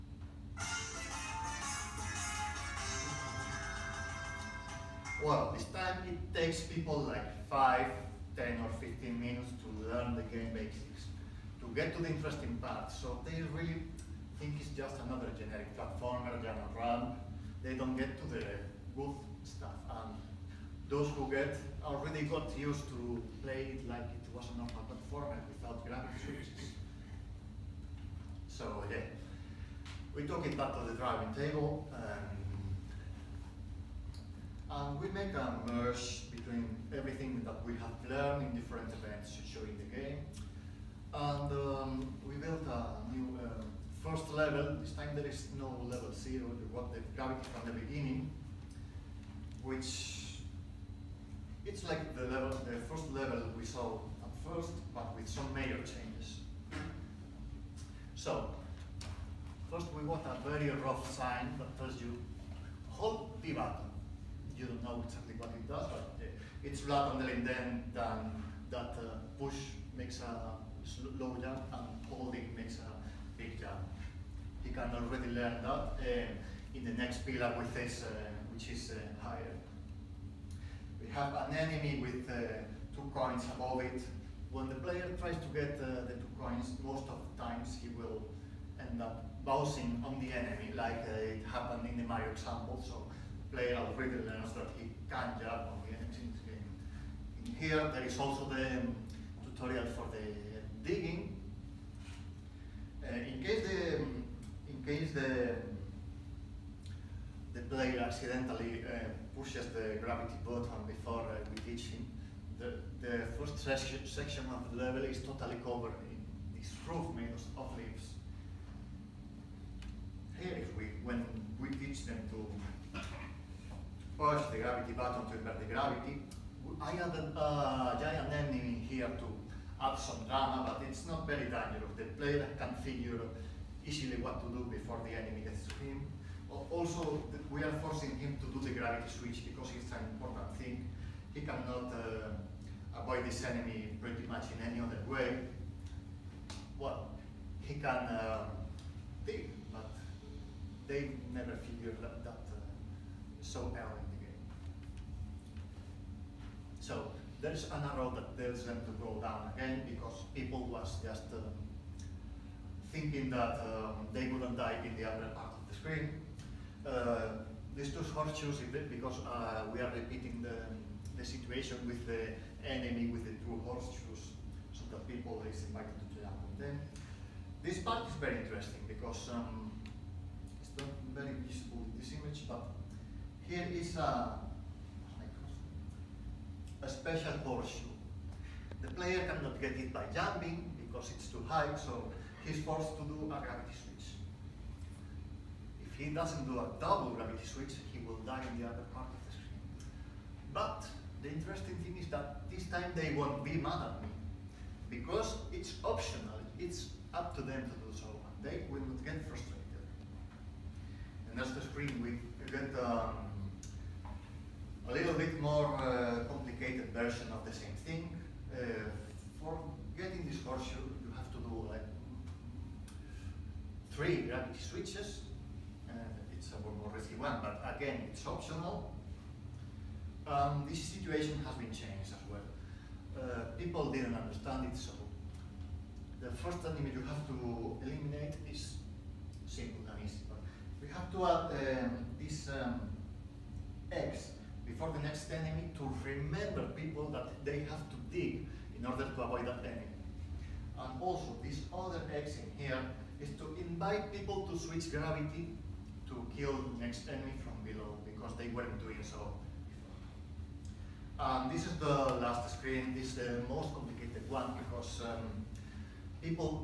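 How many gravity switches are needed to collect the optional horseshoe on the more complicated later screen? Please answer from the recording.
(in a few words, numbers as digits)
3.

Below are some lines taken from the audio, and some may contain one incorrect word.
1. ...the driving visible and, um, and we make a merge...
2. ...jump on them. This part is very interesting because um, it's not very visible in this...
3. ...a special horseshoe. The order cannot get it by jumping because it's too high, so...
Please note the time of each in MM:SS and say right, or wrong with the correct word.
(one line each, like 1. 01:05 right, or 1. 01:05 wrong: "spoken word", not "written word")
1. 00:30 wrong: "table", not "visible"
2. 02:56 right
3. 03:06 wrong: "player", not "order".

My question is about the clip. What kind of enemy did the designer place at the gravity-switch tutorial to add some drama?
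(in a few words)
giant enemy.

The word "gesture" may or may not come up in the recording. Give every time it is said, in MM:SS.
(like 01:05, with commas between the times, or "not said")
not said.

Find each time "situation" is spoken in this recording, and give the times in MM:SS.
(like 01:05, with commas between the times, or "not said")
02:51, 03:50.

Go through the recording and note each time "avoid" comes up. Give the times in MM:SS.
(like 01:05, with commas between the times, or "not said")
02:22, 04:09.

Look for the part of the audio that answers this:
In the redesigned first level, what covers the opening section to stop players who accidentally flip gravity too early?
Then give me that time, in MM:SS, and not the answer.
01:56.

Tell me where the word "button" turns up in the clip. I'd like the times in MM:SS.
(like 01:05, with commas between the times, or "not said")
01:03, 01:50, 02:04.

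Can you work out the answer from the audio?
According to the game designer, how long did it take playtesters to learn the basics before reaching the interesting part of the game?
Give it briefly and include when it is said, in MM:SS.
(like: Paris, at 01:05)
5, 10 or 15 minutes, at 00:07.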